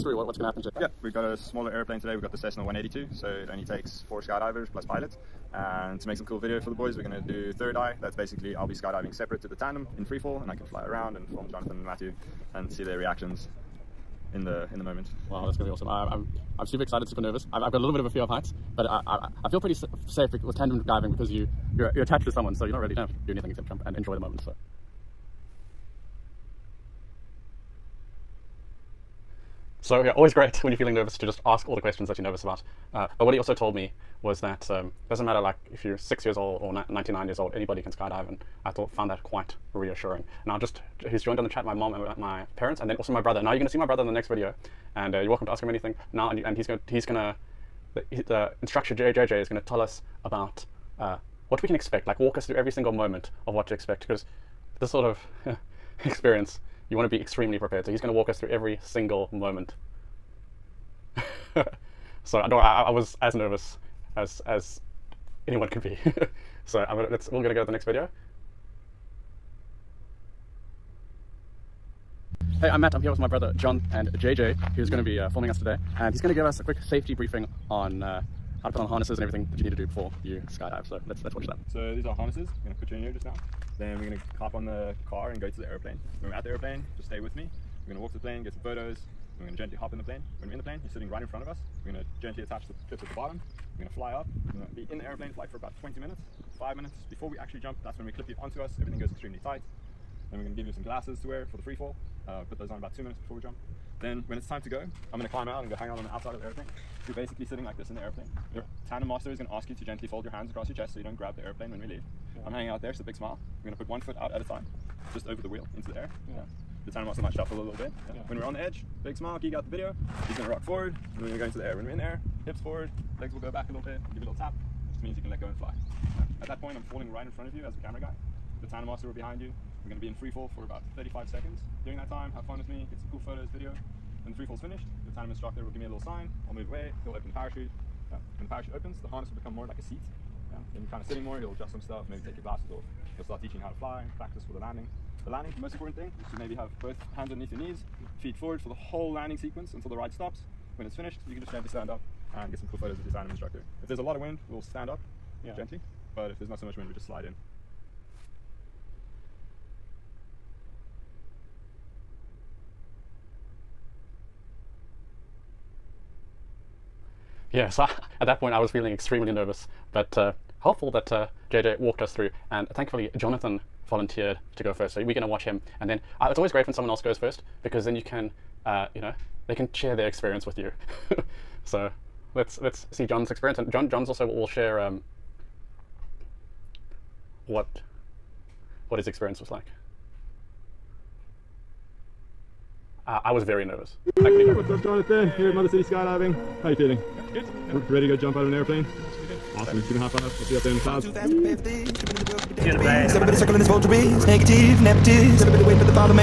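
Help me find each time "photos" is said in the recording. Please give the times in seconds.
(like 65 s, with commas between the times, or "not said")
88 s, 133 s, 152 s.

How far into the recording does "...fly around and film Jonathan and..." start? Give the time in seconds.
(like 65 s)
10 s.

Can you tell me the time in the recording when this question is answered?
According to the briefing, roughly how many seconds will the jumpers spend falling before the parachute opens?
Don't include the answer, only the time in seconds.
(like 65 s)
130 s.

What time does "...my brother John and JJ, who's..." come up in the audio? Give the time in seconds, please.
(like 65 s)
73 s.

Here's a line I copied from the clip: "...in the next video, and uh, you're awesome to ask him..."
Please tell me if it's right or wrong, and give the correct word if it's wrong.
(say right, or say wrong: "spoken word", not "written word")
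wrong: "welcome", not "awesome".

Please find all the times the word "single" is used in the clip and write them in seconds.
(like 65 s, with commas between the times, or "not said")
52 s, 58 s.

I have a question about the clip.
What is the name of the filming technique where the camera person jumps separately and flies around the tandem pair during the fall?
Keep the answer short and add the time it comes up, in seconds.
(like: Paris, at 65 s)
third eye, at 7 s.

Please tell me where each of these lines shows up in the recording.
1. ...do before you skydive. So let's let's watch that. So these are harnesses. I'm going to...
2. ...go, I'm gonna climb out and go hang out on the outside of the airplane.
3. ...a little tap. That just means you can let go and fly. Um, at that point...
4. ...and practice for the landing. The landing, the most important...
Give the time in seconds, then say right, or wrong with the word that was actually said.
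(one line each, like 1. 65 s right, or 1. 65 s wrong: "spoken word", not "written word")
1. 79 s right
2. 104 s right
3. 124 s right
4. 144 s right.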